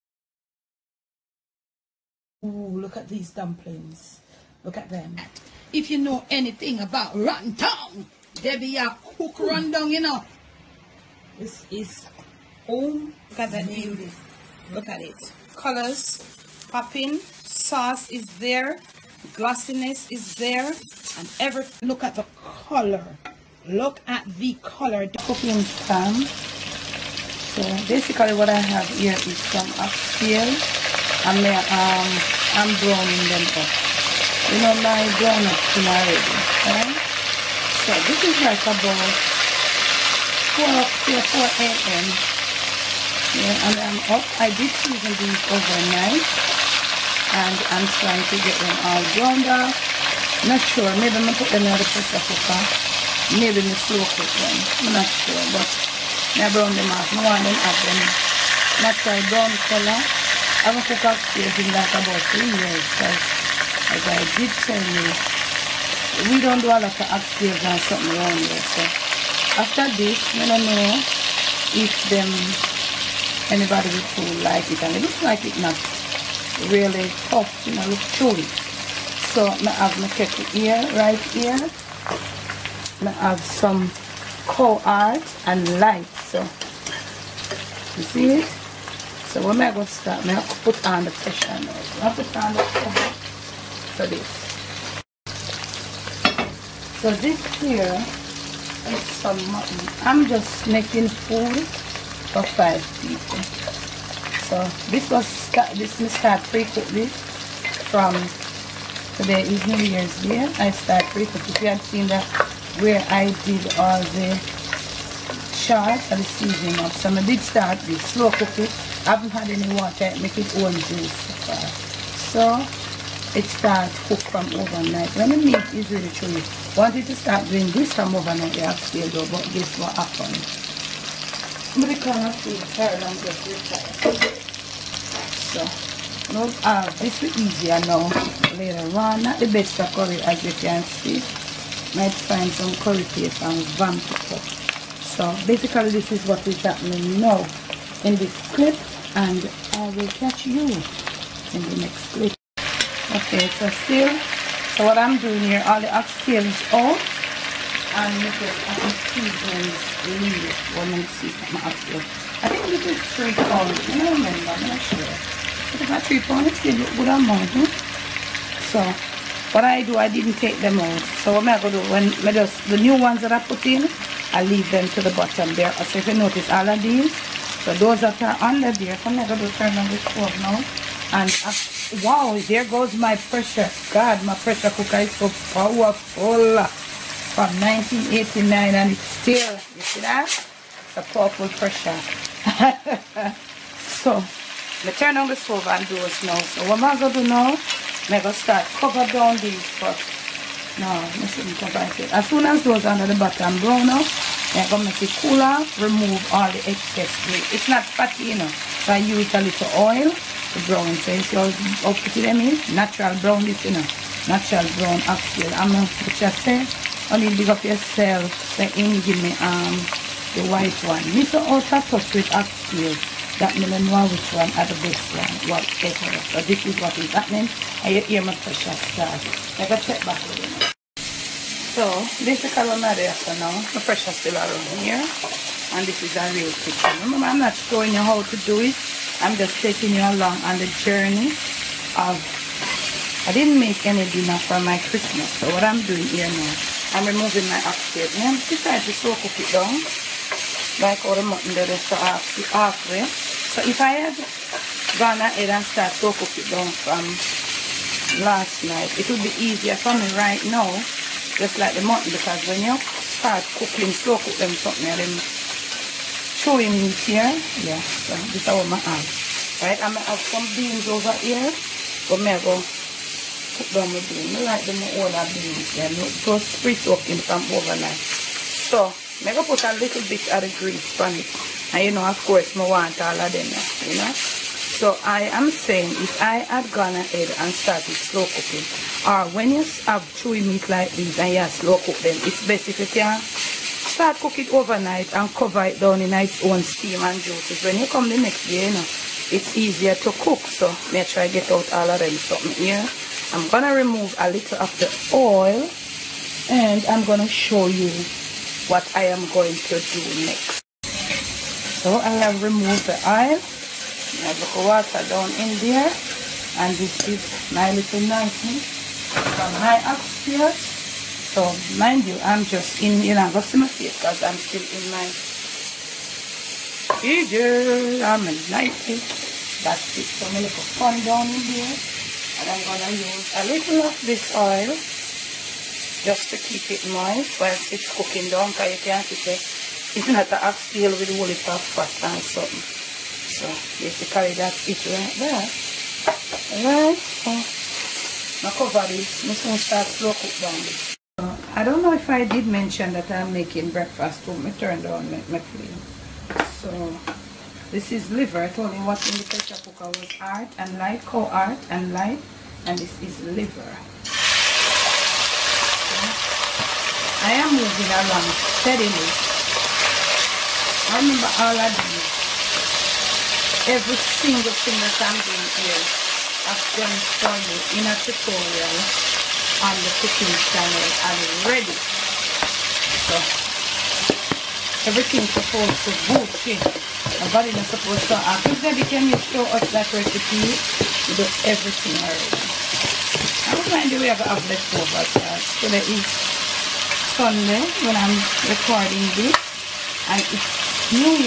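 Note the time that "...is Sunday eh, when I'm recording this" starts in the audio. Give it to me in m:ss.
6:35.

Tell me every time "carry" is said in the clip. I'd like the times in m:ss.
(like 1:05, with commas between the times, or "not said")
5:44.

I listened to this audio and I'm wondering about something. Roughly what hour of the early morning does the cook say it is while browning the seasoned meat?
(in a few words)
4 a.m.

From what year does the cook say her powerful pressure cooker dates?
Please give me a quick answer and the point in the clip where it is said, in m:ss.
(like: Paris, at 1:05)
1989, at 3:07.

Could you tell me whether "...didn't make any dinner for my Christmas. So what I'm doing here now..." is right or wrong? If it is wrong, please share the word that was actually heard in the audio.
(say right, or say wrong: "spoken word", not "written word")
right.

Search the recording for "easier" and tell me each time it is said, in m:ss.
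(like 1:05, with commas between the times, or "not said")
2:17, 4:19, 4:59.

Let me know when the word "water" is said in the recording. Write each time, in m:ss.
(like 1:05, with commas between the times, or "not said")
1:59, 5:14.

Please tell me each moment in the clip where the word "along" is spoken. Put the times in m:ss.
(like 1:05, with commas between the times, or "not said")
3:59, 6:07.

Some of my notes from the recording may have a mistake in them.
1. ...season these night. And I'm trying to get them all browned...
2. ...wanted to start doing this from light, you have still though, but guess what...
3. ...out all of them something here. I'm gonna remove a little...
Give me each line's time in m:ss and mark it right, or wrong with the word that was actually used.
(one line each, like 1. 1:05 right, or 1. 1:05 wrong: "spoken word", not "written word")
1. 0:44 wrong: "overnight", not "night"
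2. 2:06 wrong: "overnight", not "light"
3. 5:01 right.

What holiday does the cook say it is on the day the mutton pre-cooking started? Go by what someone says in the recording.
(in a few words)
New Year's Day.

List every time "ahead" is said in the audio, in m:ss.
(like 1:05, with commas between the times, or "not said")
4:15, 4:46.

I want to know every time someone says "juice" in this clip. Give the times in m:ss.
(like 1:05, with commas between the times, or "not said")
2:00, 4:57.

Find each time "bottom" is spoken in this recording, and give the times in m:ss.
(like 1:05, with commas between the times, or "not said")
2:55, 3:23.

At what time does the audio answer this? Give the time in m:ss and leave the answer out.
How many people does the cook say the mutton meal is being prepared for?
1:42.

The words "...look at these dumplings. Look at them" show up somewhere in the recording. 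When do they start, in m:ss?
0:02.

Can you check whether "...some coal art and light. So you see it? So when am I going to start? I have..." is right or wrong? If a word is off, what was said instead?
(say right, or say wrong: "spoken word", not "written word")
right.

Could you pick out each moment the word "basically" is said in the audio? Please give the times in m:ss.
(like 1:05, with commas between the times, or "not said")
0:27, 2:25.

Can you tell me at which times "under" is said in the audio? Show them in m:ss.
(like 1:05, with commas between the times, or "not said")
2:58, 3:22.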